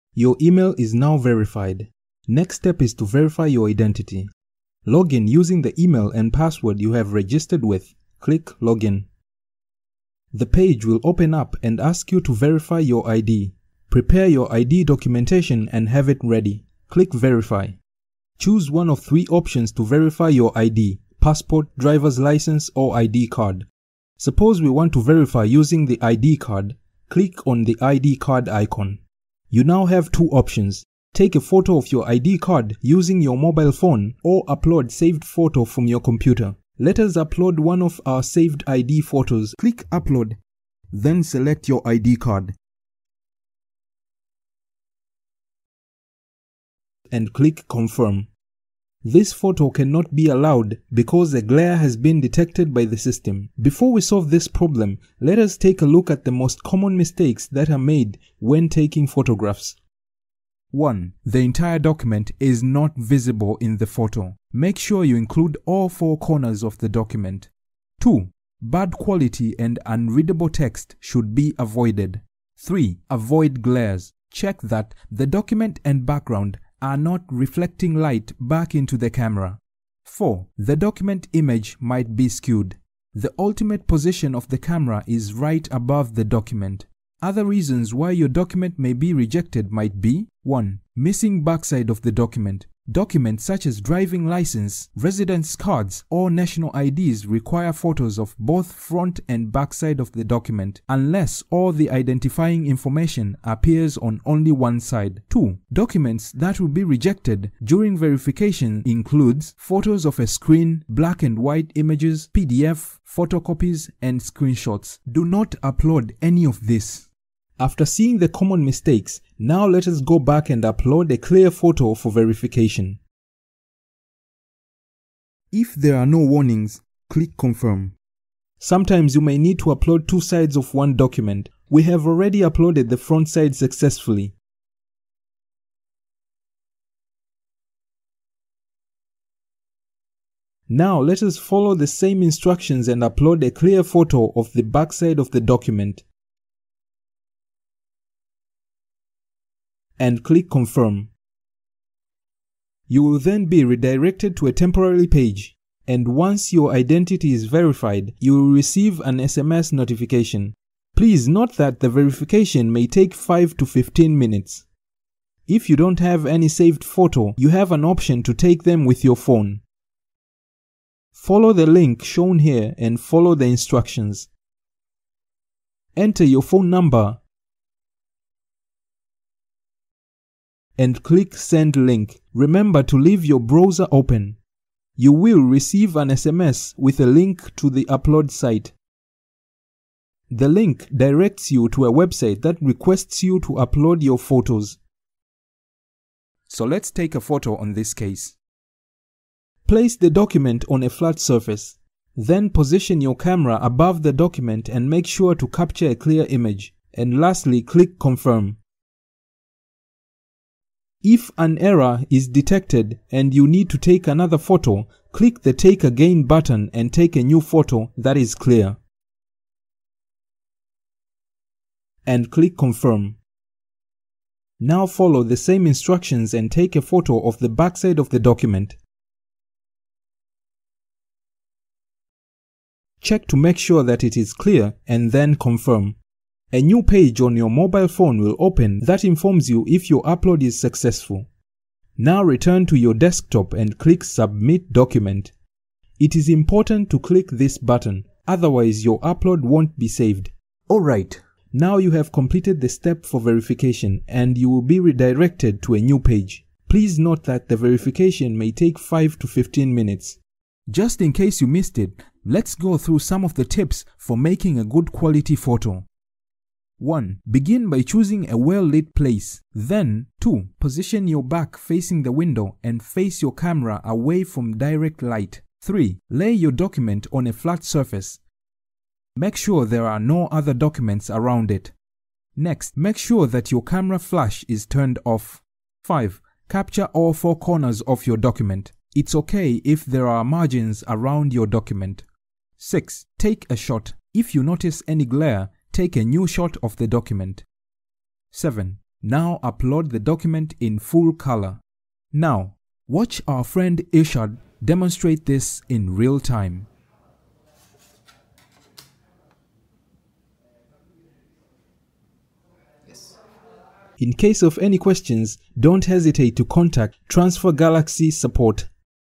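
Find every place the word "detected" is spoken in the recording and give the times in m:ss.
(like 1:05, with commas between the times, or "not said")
0:52, 3:32.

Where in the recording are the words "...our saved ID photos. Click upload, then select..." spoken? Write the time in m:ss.
0:38.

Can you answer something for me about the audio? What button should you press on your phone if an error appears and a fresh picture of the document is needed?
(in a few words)
Take Again.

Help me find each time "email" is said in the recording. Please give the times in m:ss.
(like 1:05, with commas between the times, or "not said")
0:00, 0:05.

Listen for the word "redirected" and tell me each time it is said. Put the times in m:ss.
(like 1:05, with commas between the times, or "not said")
2:33, 4:14.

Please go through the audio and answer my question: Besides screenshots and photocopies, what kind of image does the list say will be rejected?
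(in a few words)
Black and white images.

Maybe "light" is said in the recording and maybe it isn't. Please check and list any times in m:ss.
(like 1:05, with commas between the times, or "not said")
1:17, 4:35.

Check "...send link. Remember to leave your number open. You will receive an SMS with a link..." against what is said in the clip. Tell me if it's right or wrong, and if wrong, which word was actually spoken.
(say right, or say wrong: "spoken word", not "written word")
wrong: "browser", not "number".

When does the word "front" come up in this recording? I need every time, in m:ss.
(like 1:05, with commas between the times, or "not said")
1:38, 2:12.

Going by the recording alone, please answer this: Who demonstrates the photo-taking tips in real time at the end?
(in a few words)
Ishad.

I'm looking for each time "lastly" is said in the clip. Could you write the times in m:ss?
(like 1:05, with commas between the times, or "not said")
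3:27.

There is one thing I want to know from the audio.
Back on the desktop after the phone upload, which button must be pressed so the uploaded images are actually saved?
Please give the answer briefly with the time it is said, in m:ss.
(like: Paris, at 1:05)
Submit Document, at 4:04.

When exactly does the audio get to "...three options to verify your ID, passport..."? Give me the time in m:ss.
0:18.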